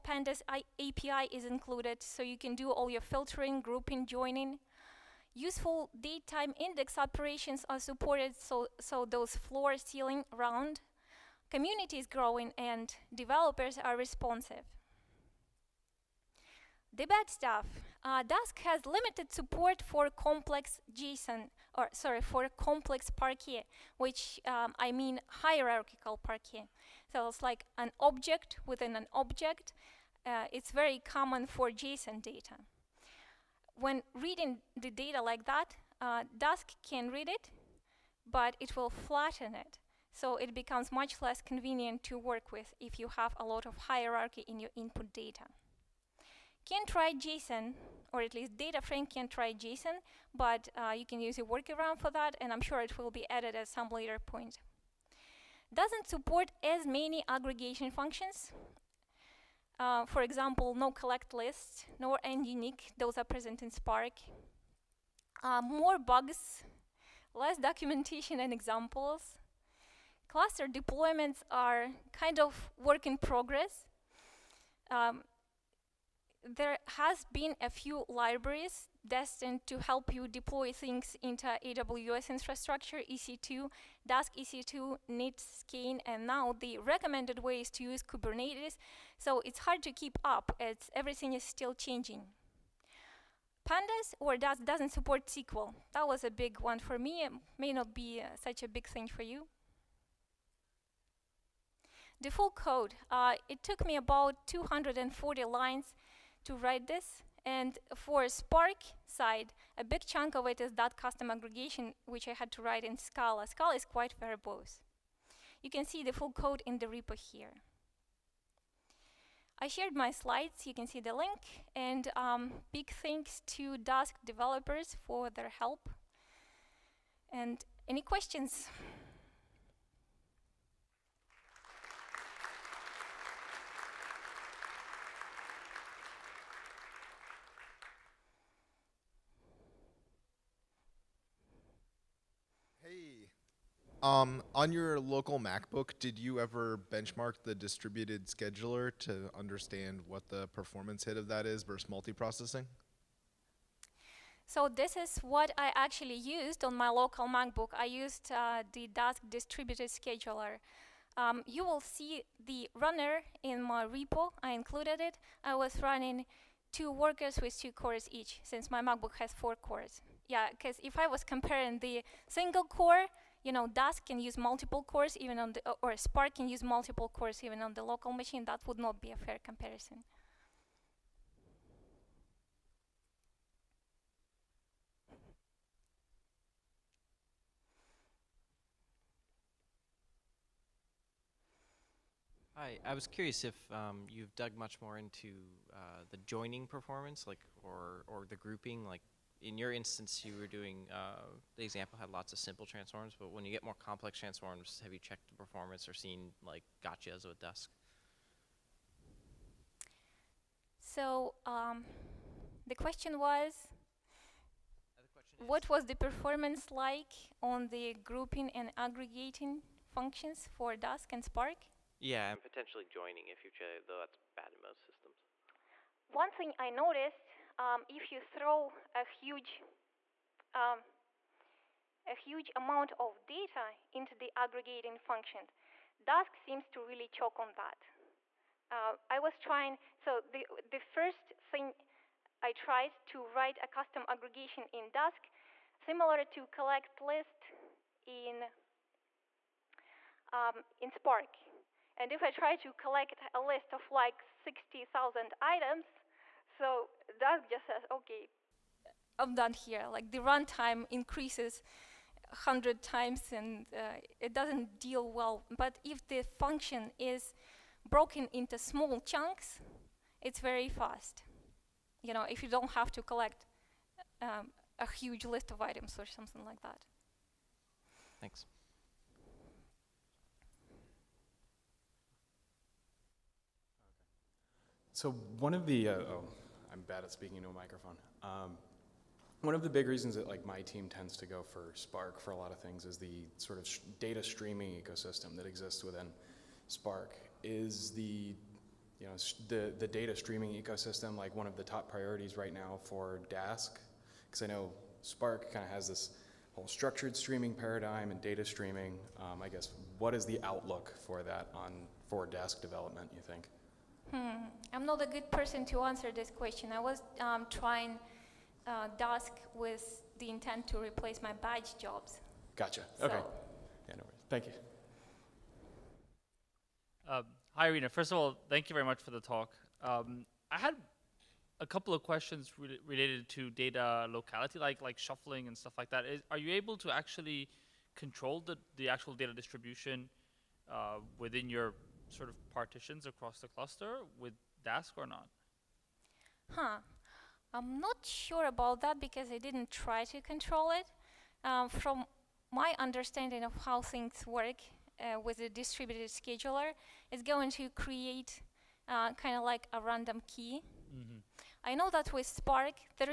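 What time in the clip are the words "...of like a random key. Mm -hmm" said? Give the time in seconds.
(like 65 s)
359 s.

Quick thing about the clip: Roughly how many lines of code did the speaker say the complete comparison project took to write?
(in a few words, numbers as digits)
240.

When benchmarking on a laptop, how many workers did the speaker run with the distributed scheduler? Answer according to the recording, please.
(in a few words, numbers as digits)
2.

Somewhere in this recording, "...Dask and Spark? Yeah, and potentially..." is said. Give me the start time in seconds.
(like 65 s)
220 s.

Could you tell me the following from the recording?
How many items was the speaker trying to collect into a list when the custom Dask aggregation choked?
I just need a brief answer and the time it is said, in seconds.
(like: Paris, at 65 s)
60,000, at 254 s.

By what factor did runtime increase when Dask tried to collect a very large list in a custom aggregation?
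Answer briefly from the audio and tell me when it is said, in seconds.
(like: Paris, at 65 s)
100, at 262 s.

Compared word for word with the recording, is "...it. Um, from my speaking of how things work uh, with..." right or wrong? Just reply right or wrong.
wrong.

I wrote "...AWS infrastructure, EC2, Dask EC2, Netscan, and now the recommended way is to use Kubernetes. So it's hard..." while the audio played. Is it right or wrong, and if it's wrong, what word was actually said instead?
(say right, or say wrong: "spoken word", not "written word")
right.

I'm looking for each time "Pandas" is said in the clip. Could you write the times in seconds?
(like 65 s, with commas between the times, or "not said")
0 s, 93 s.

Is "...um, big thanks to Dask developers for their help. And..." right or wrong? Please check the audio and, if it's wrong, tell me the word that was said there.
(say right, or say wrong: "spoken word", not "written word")
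right.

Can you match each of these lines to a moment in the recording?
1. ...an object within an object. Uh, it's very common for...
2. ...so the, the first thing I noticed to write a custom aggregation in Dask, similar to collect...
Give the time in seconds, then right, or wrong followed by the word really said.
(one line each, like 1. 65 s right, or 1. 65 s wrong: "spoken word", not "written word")
1. 27 s right
2. 239 s wrong: "tried", not "noticed".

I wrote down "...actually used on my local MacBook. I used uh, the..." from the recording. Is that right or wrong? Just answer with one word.
right.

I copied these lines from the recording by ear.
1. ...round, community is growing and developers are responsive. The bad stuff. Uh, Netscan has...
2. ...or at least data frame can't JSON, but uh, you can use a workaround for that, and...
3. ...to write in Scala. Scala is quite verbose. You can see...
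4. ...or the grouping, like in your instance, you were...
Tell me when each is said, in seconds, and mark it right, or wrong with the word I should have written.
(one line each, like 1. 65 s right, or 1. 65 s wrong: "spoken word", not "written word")
1. 10 s wrong: "Dask", not "Netscan"
2. 48 s right
3. 112 s right
4. 198 s right.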